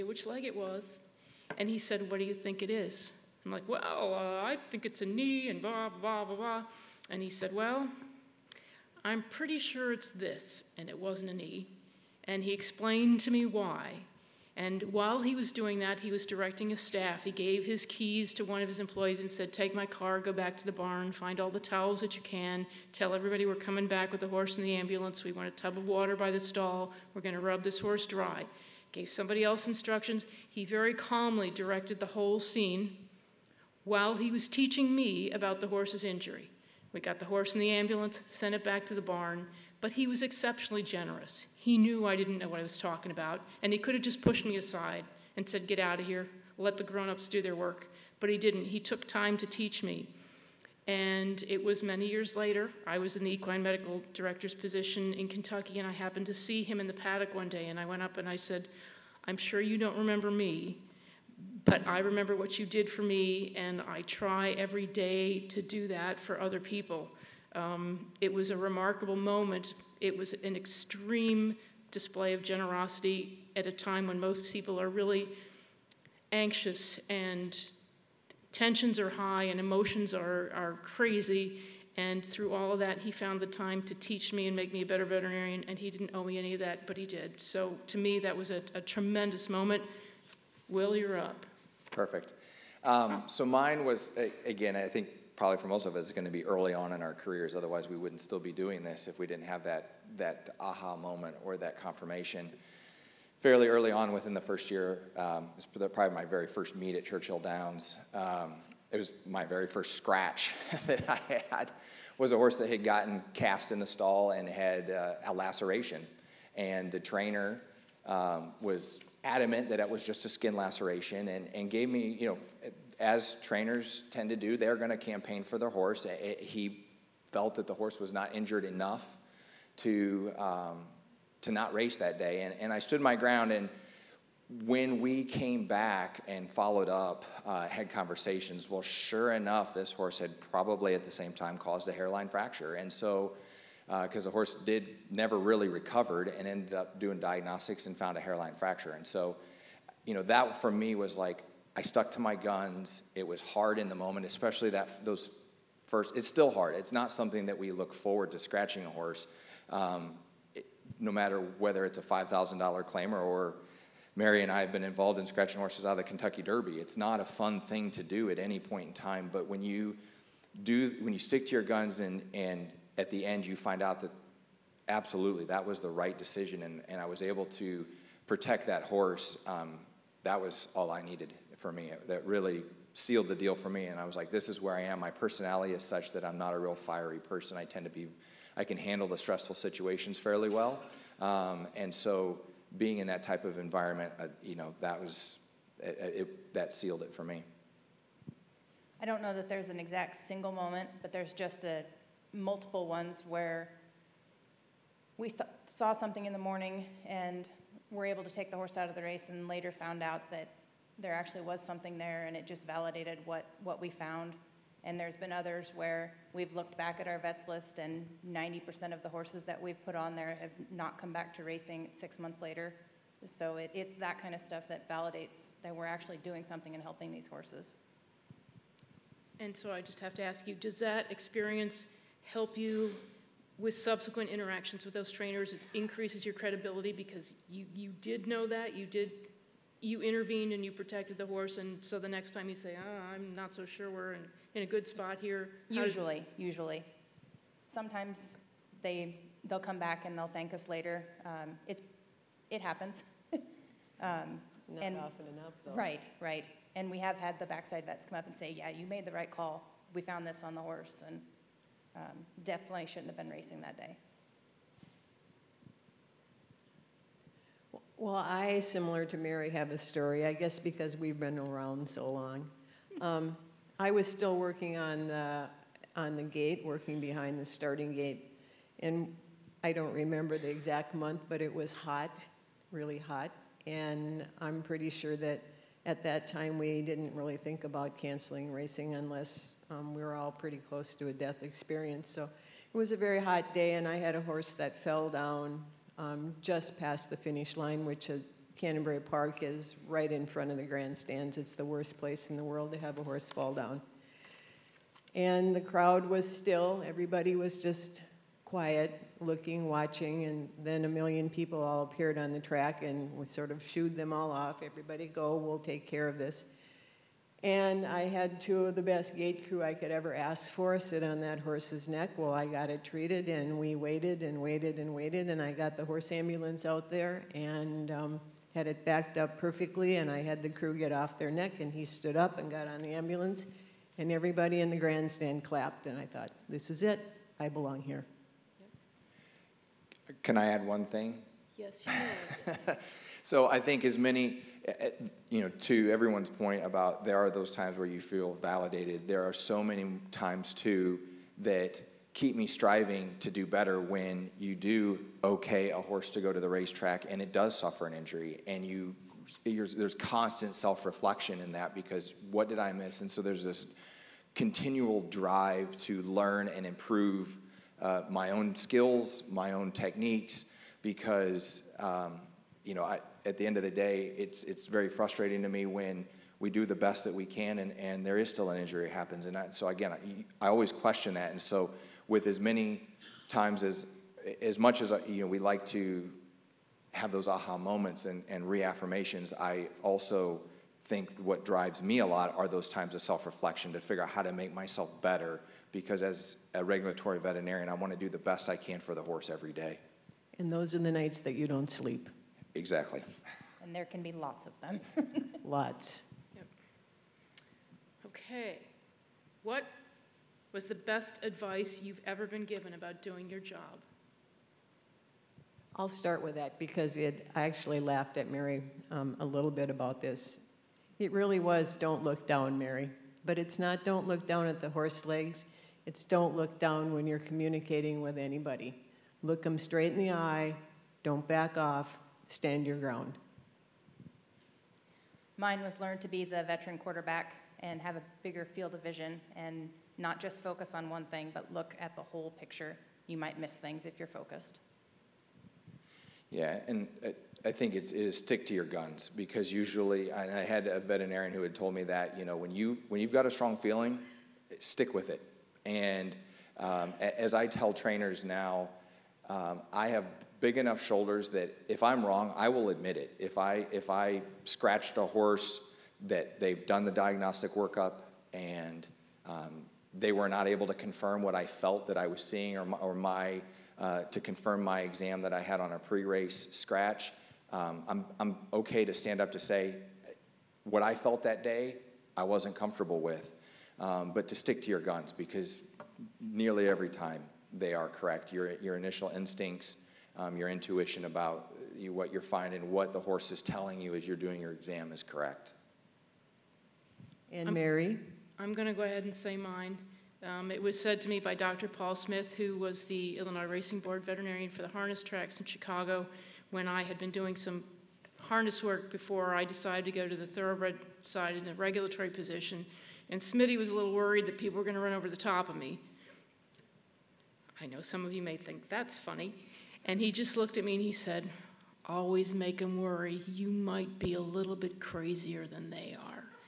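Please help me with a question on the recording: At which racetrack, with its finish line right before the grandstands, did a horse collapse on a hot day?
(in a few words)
Canterbury Park.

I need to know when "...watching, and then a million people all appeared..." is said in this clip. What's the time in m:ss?
5:09.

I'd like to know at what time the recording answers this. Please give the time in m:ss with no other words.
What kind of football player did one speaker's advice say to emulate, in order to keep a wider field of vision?
7:16.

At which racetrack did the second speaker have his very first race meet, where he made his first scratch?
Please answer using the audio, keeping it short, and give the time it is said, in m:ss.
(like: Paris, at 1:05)
Churchill Downs, at 1:47.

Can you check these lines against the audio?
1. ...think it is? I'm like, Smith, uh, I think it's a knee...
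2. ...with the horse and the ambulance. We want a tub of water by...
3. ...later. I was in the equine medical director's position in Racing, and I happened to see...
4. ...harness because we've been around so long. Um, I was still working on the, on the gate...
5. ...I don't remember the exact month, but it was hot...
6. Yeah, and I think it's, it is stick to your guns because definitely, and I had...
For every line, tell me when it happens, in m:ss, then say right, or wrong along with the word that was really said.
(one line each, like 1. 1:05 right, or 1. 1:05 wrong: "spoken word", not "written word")
1. 0:02 wrong: "Well", not "Smith"
2. 0:24 right
3. 0:52 wrong: "Kentucky", not "Racing"
4. 4:30 wrong: "guess", not "harness"
5. 4:39 right
6. 7:26 wrong: "usually", not "definitely".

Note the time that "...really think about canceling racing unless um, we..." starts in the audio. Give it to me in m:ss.
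4:47.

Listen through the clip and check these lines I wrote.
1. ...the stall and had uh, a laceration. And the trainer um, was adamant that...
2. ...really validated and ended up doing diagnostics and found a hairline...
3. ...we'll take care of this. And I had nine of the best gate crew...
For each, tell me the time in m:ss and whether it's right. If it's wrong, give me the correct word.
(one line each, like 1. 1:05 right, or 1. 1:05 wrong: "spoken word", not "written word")
1. 1:53 right
2. 2:25 wrong: "recovered", not "validated"
3. 5:15 wrong: "two", not "nine".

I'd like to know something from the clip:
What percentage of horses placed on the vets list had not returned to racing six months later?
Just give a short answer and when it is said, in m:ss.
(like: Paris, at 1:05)
90%, at 3:38.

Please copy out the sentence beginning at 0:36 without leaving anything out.
We got the horse in the ambulance, sent it back to the barn.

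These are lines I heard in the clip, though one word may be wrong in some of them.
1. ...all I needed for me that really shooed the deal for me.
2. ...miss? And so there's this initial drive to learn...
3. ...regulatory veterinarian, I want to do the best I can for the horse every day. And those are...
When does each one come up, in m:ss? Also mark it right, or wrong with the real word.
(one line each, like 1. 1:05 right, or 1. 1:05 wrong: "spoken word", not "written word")
1. 3:00 wrong: "sealed", not "shooed"
2. 6:02 wrong: "continual", not "initial"
3. 6:36 right.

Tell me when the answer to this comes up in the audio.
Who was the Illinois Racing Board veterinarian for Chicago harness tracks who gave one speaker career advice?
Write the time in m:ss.
8:21.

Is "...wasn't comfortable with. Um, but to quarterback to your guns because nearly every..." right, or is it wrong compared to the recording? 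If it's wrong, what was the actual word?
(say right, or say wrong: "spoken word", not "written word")
wrong: "stick", not "quarterback".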